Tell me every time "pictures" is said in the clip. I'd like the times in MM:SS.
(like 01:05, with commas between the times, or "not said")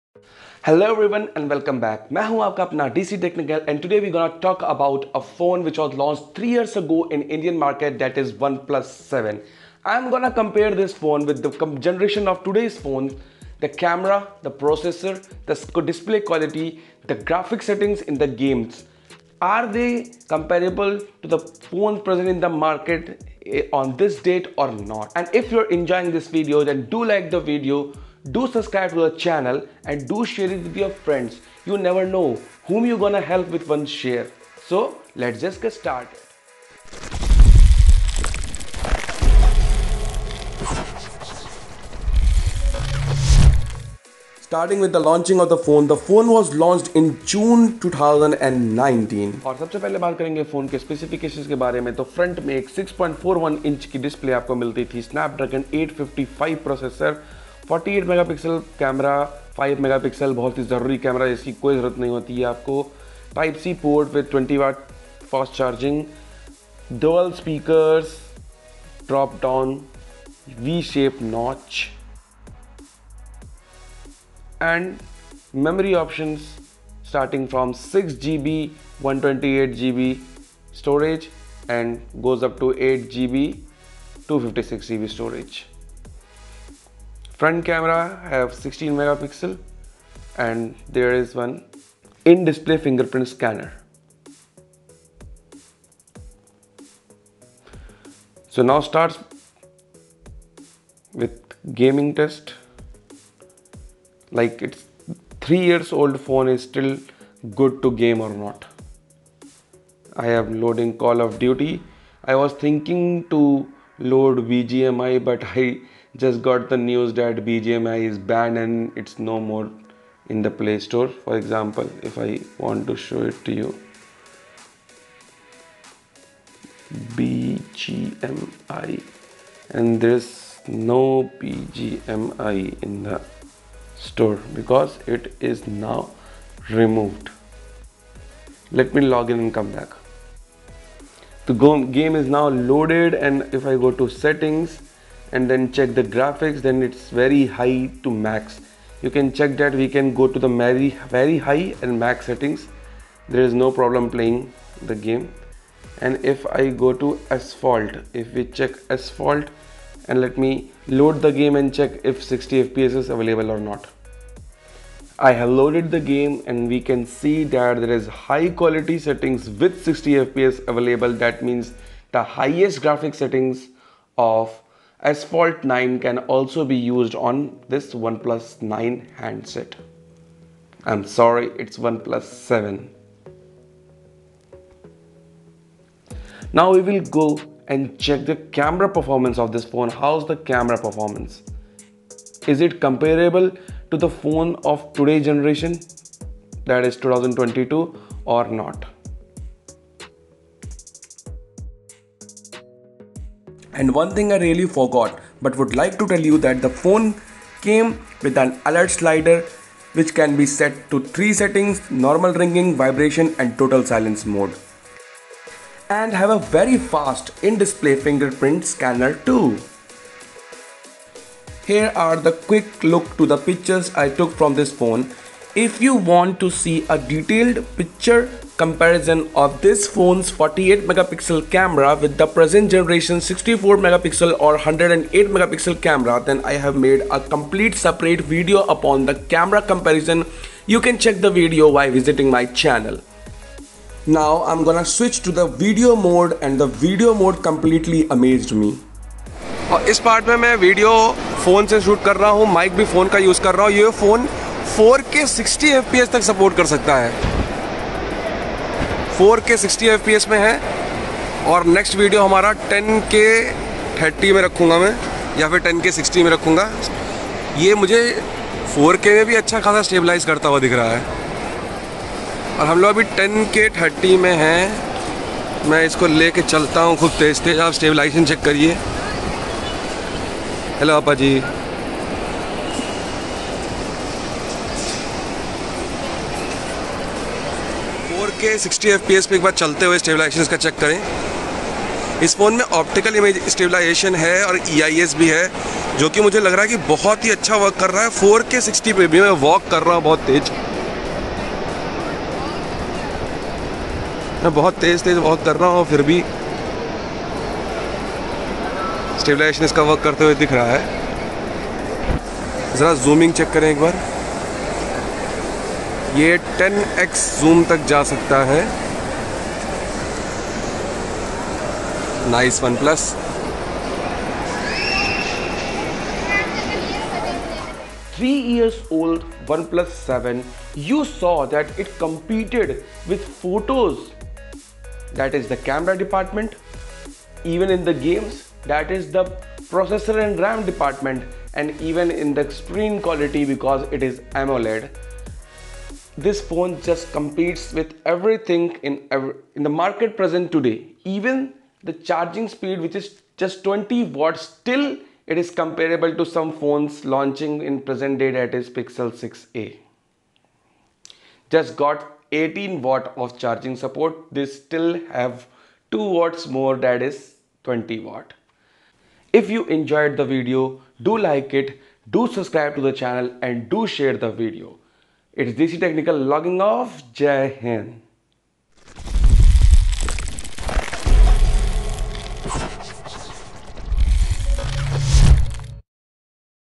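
03:43, 03:47.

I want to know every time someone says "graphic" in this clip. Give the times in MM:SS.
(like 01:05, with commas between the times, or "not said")
00:17, 02:26, 02:52.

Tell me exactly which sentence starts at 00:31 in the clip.
You never know whom you're gonna help with one share.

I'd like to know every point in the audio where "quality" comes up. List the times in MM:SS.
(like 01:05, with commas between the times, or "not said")
00:16, 02:48.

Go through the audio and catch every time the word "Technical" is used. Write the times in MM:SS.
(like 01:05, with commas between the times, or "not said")
00:03, 06:15.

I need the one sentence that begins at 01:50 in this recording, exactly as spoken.
I am loading Call of Duty.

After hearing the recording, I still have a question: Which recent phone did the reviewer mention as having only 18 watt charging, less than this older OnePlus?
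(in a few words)
Pixel 6a.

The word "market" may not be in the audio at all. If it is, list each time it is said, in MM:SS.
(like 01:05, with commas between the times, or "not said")
00:07, 00:22, 05:49.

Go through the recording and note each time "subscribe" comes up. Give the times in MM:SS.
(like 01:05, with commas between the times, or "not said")
00:28, 06:12.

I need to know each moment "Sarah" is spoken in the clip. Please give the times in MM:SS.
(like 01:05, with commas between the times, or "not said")
not said.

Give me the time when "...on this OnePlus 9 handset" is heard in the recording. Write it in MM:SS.
02:57.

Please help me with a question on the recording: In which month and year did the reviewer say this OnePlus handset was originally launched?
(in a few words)
June 2019.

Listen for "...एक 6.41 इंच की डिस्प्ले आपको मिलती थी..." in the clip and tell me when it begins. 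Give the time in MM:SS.
00:52.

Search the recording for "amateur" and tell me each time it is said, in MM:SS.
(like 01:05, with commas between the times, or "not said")
not said.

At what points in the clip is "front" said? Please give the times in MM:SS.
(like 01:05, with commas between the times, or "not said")
01:27.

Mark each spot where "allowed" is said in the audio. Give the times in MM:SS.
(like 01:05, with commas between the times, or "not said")
not said.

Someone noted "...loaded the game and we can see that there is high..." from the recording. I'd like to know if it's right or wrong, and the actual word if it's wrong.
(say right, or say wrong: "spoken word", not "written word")
right.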